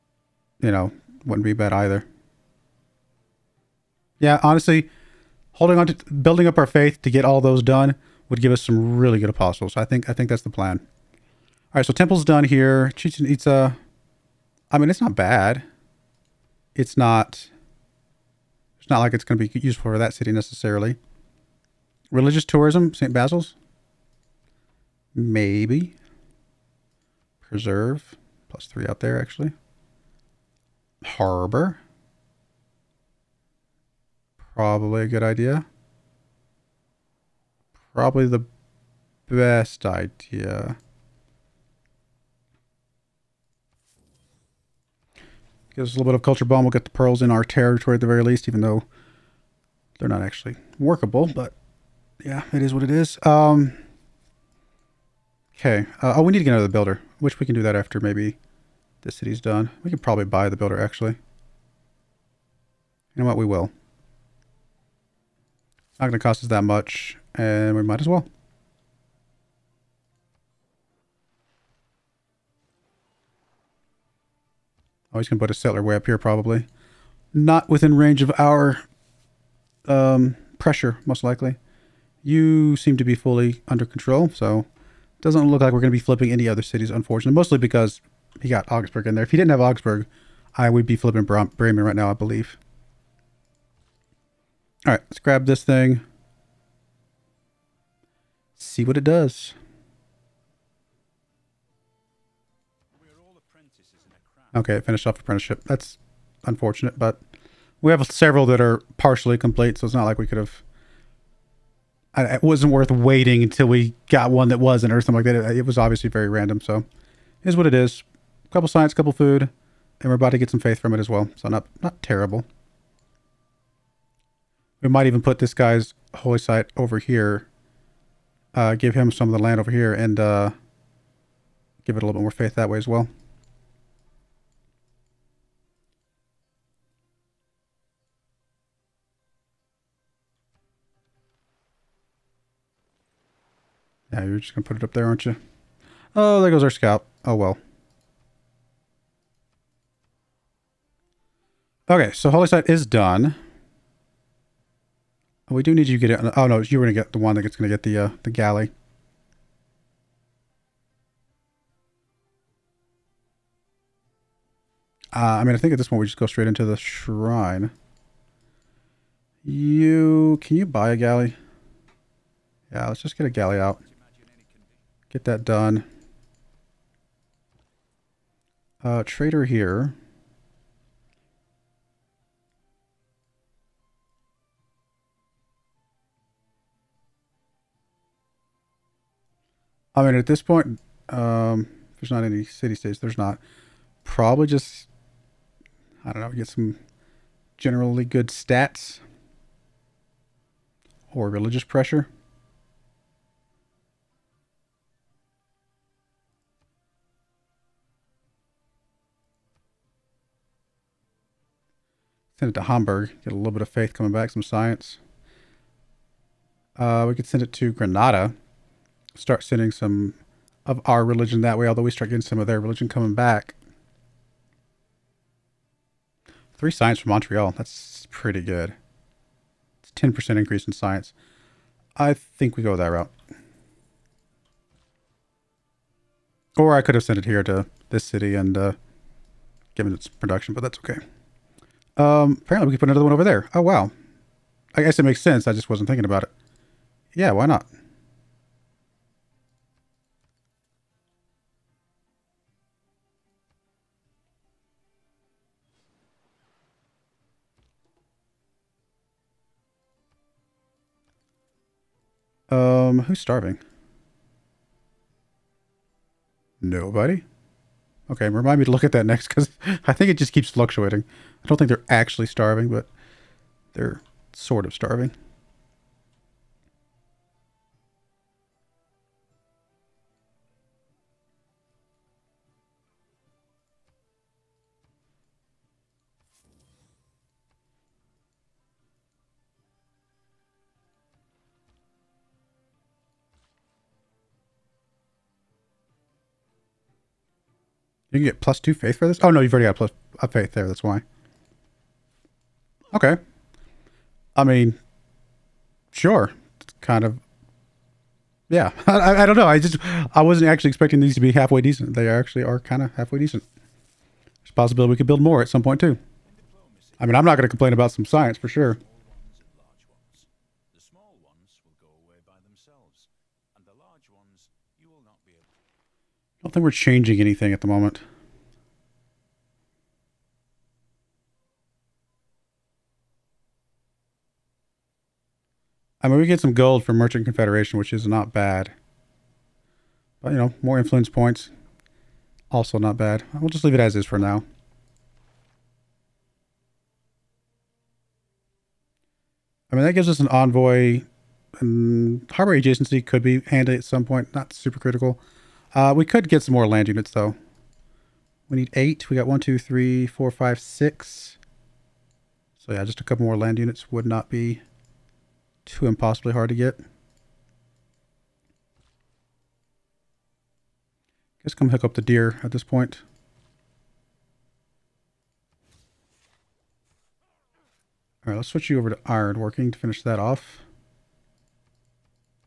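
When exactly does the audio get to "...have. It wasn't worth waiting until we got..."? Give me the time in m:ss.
1:50.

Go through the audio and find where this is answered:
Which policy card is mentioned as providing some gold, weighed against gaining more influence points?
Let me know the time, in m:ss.
5:36.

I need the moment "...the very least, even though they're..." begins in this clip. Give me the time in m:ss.
0:48.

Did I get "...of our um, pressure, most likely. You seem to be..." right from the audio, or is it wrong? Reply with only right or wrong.
right.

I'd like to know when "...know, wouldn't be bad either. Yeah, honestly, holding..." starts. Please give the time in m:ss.
0:00.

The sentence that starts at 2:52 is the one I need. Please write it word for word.
Yeah, let's just get a galley out get that done.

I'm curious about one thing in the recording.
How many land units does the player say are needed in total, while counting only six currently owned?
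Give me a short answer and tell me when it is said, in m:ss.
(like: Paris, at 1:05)
8, at 5:58.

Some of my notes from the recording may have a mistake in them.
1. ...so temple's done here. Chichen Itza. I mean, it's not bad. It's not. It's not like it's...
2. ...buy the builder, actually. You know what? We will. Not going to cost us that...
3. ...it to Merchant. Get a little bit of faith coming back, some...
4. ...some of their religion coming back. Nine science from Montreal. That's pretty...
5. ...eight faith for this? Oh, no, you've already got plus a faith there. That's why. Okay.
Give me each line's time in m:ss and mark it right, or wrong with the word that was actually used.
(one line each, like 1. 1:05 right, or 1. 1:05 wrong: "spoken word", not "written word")
1. 0:11 right
2. 1:00 right
3. 3:32 wrong: "Hamburg", not "Merchant"
4. 3:42 wrong: "Three", not "Nine"
5. 4:58 wrong: "two", not "eight".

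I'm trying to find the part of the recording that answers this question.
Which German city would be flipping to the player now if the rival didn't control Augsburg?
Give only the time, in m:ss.
1:31.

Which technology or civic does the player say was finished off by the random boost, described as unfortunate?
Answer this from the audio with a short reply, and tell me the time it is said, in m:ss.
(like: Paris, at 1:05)
Apprenticeship, at 1:45.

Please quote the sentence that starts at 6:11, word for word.
Guess come hook up the deer at this point.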